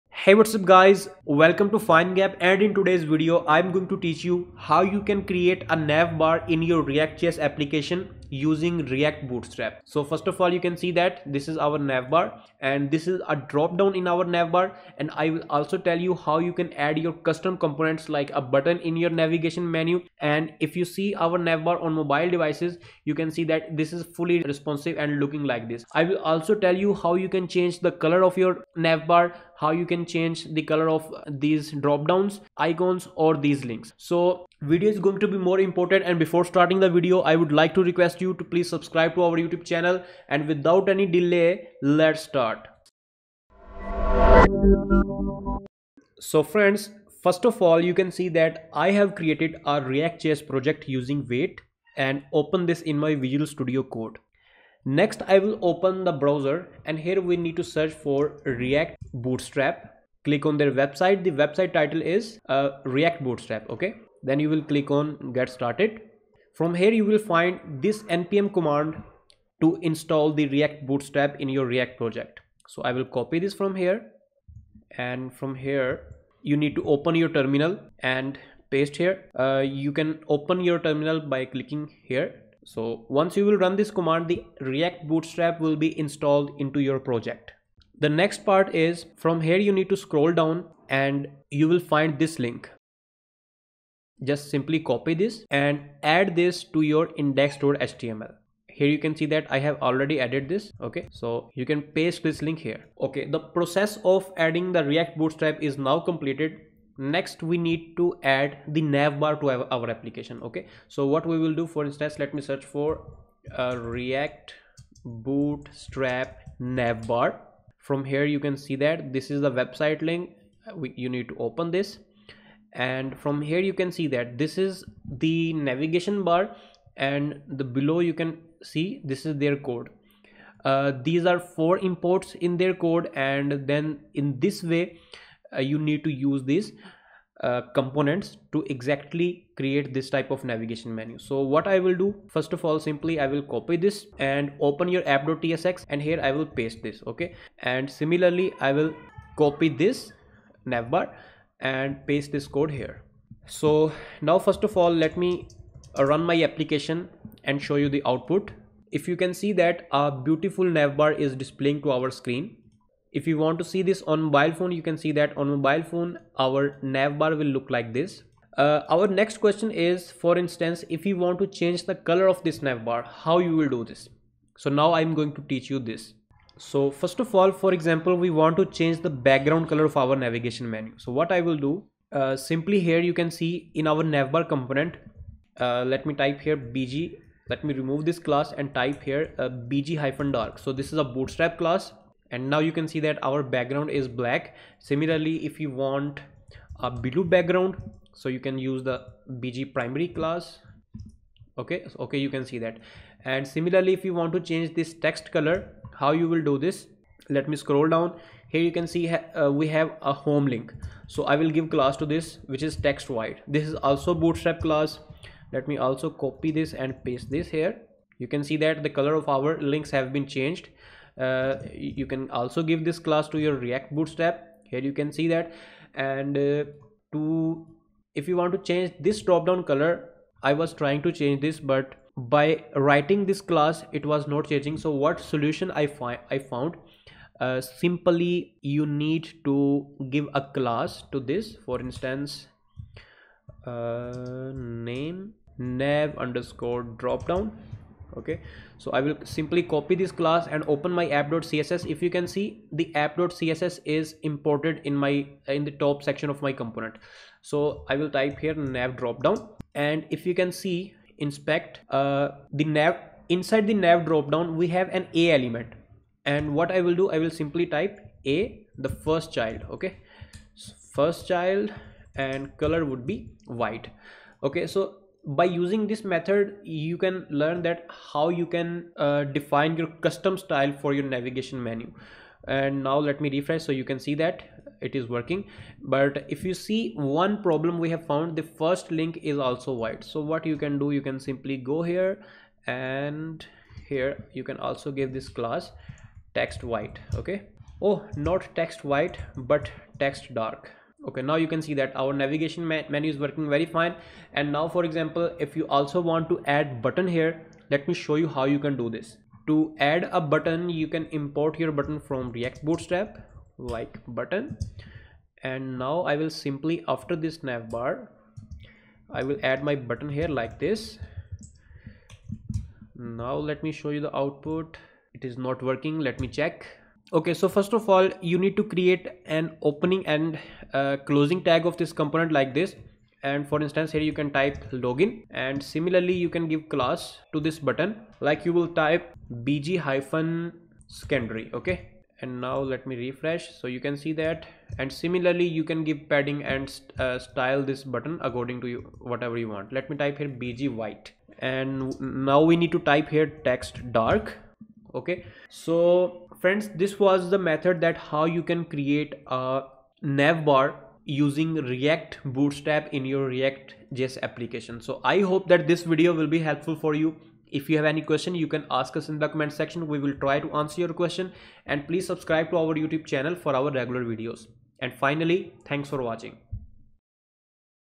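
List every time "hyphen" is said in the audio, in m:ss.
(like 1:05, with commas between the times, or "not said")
5:39.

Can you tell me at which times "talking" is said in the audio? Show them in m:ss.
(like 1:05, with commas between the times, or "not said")
not said.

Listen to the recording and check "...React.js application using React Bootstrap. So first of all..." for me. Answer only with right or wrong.
right.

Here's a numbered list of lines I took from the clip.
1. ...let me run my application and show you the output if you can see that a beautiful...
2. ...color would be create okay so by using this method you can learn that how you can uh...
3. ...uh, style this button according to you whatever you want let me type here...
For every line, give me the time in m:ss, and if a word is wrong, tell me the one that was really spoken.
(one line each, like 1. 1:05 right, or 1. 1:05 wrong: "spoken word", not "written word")
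1. 2:34 right
2. 4:32 wrong: "white", not "create"
3. 5:46 right.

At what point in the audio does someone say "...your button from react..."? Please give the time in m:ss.
5:11.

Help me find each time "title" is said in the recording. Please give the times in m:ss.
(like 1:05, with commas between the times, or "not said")
1:01.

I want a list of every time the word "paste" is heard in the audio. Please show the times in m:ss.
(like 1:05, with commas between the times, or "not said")
1:18, 1:41, 2:26, 2:32, 3:37.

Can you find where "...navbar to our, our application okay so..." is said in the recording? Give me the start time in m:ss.
1:48.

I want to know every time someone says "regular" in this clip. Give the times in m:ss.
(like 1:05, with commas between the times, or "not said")
6:13.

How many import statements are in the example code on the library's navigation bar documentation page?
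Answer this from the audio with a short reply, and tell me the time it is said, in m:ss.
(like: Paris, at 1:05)
4, at 2:11.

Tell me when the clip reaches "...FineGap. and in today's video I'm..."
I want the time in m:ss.
0:01.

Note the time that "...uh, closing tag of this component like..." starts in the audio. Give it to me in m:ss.
5:30.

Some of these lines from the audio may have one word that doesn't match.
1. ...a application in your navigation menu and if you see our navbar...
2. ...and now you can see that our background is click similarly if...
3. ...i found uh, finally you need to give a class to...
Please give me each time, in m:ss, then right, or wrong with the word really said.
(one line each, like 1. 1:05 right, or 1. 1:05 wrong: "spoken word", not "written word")
1. 0:18 wrong: "button", not "application"
2. 3:12 wrong: "black", not "click"
3. 3:56 wrong: "simply", not "finally".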